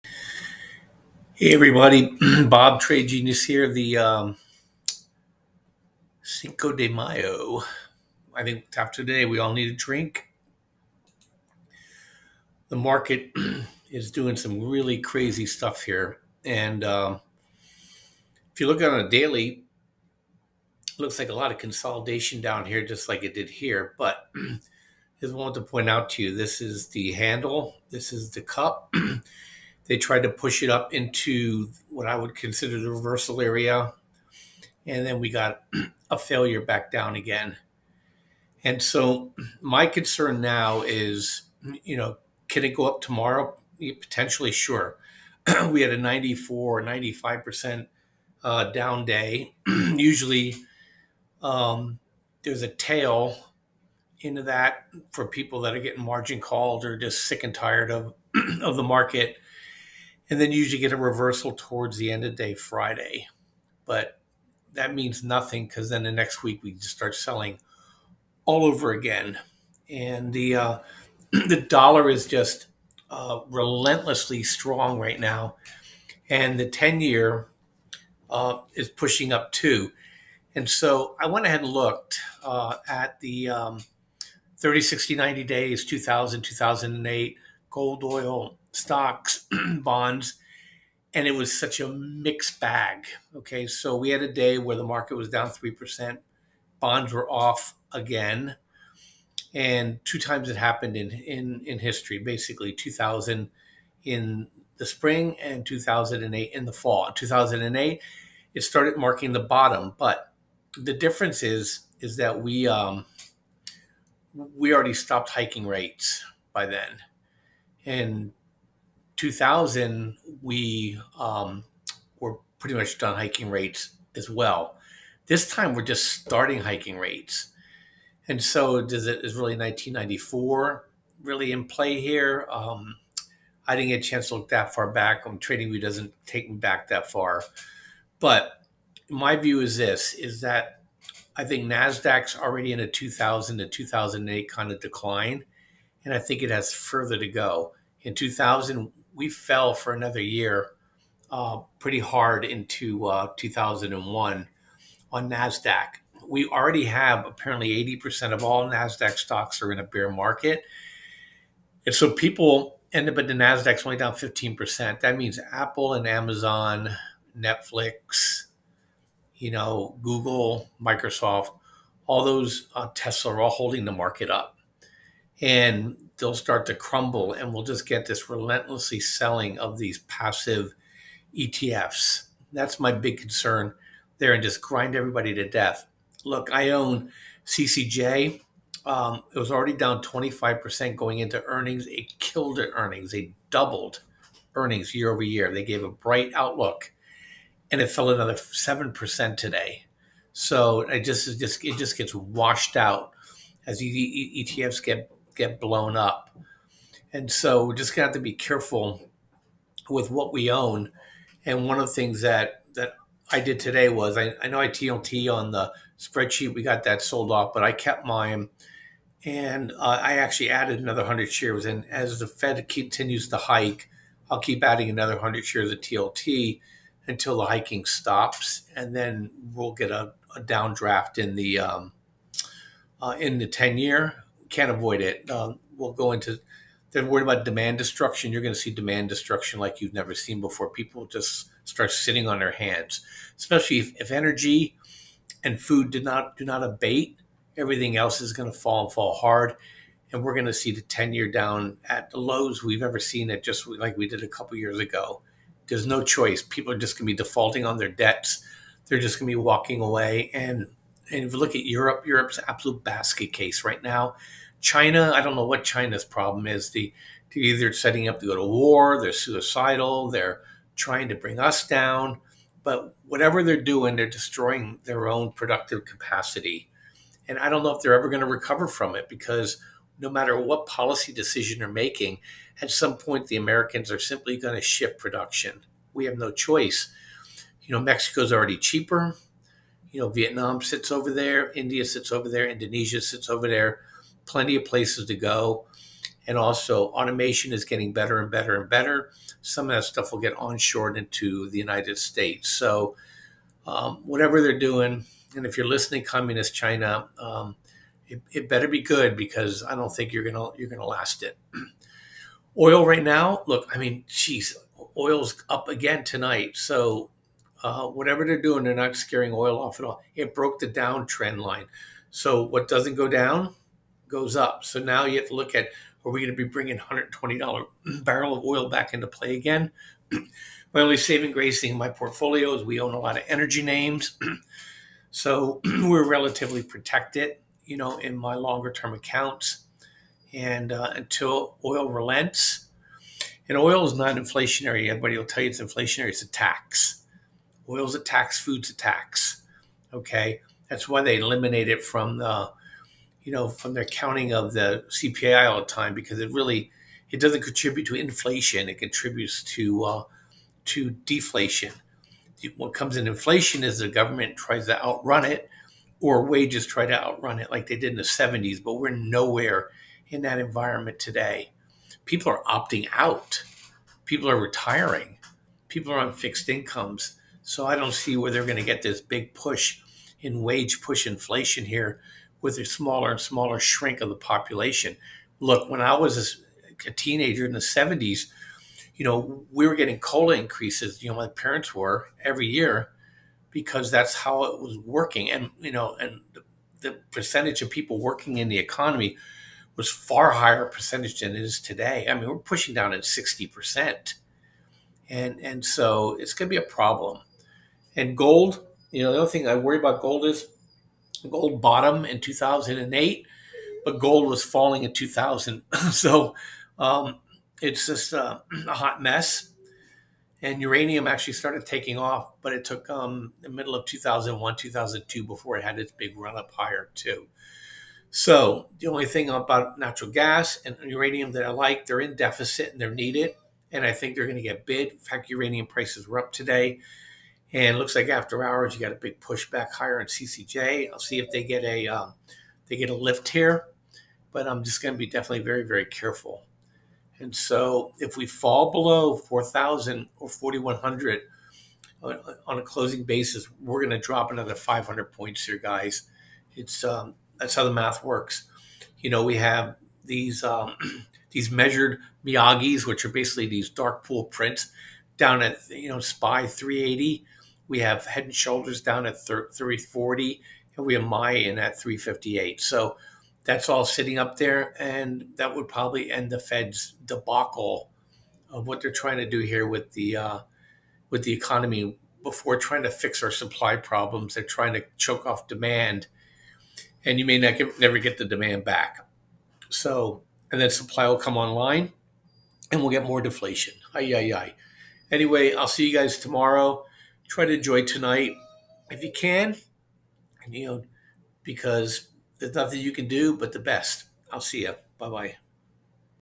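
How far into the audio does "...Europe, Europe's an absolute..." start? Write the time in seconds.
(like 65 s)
261 s.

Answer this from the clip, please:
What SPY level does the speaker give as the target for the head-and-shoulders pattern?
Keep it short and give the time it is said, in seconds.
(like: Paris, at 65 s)
340, at 469 s.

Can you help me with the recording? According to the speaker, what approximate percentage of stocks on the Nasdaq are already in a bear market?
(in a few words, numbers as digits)
80%.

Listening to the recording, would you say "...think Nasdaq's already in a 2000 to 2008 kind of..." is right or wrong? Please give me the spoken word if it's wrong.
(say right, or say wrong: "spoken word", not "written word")
right.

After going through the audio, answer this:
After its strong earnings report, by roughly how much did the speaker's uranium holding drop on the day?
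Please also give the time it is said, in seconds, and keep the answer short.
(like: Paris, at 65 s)
7%, at 198 s.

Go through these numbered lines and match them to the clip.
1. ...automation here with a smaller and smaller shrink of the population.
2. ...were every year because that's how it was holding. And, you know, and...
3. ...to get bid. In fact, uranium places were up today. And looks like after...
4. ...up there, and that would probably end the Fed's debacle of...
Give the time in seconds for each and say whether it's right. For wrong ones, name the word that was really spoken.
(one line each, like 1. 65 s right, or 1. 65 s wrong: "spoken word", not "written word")
1. 381 s wrong: "inflation", not "automation"
2. 391 s wrong: "working", not "holding"
3. 434 s wrong: "prices", not "places"
4. 474 s right.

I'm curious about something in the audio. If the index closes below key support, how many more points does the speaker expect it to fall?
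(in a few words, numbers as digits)
500.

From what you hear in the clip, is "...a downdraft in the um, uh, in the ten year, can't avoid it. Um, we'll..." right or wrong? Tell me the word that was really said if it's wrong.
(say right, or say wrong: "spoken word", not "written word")
right.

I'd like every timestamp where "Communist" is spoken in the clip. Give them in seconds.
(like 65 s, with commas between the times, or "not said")
306 s.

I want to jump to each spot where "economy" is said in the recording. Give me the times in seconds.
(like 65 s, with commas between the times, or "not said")
398 s, 481 s.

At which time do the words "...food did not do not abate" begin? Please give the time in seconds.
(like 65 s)
245 s.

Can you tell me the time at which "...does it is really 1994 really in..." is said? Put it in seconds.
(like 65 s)
128 s.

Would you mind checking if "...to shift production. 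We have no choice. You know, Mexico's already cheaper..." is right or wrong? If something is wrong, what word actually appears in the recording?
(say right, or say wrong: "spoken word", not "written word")
right.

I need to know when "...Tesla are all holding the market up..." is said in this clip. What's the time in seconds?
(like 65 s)
172 s.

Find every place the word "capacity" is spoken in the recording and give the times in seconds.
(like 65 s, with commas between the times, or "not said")
275 s.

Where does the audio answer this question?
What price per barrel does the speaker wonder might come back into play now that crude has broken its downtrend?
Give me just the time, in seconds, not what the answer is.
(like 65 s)
326 s.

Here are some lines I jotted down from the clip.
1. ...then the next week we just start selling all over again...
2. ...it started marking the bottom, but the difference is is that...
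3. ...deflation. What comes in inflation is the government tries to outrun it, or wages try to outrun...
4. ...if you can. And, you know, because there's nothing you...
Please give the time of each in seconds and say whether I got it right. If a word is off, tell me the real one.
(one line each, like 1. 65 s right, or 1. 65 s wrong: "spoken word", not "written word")
1. 65 s right
2. 108 s right
3. 360 s right
4. 498 s right.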